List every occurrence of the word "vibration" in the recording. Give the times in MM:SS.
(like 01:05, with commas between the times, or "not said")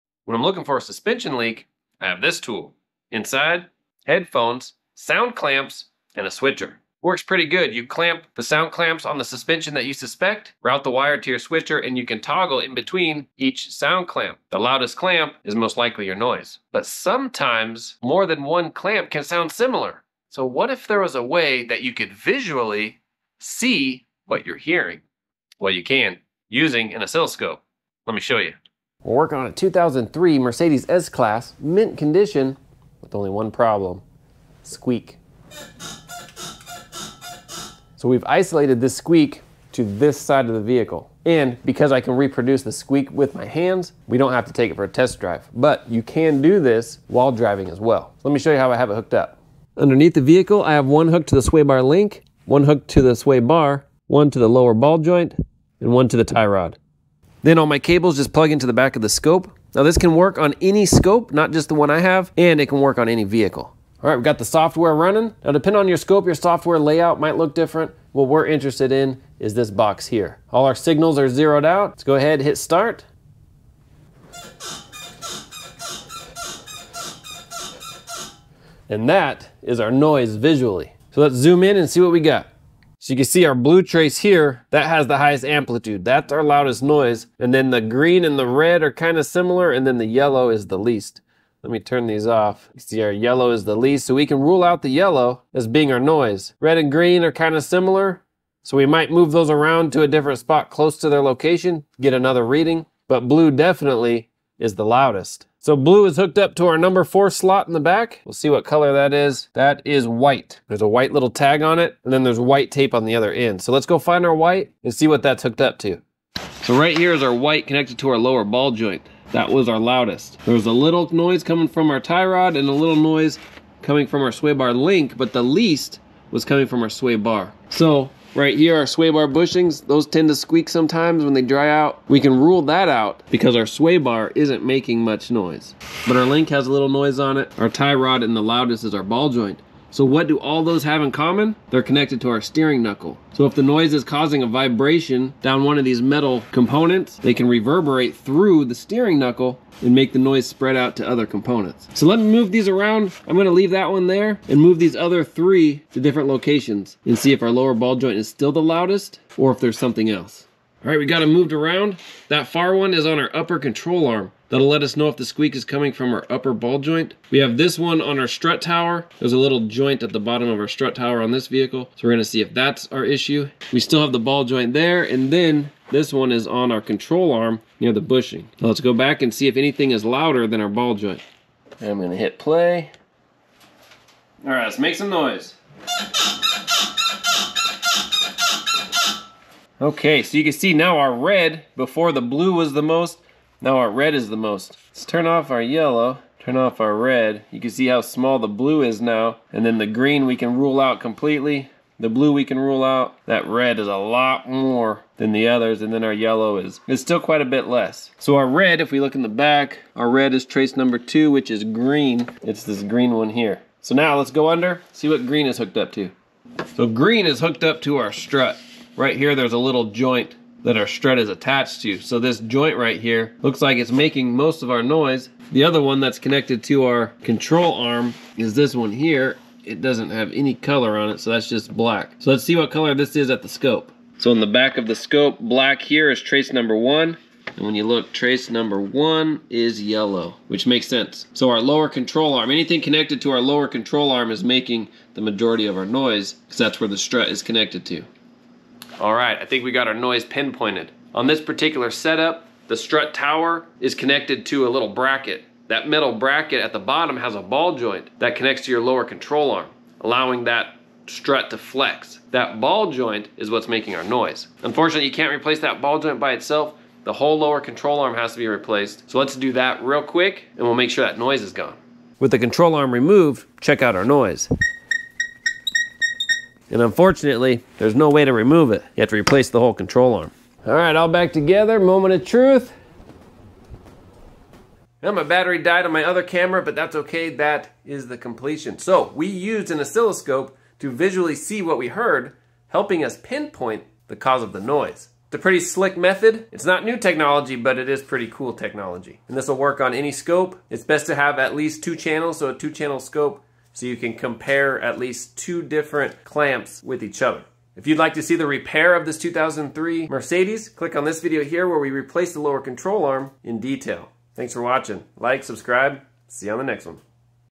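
02:24.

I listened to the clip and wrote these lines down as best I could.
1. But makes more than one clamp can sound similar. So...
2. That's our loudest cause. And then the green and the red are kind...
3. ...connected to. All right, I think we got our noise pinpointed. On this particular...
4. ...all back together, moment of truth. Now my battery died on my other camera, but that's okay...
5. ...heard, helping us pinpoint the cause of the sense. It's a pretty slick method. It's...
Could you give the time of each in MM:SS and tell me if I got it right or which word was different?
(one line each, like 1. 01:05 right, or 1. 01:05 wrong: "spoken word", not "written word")
1. 00:16 wrong: "sometimes", not "makes"
2. 01:26 wrong: "noise", not "cause"
3. 04:07 right
4. 04:40 right
5. 04:51 wrong: "noise", not "sense".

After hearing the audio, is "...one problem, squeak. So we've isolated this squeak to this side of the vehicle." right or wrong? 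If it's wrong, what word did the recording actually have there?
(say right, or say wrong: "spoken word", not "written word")
right.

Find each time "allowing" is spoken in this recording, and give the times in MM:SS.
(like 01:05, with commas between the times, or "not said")
04:20.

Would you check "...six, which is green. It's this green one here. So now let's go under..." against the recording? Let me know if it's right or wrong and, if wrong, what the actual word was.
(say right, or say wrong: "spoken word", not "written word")
wrong: "two", not "six".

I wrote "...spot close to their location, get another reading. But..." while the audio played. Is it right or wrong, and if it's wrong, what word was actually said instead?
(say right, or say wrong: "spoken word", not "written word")
right.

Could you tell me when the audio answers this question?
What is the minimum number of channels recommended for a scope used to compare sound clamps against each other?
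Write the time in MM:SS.
05:02.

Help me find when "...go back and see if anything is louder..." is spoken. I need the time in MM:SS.
02:58.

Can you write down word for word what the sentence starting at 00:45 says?
But you can do this while driving as well.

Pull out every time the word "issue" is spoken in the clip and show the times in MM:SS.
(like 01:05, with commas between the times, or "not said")
02:53.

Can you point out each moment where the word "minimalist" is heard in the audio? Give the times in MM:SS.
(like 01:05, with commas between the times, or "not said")
not said.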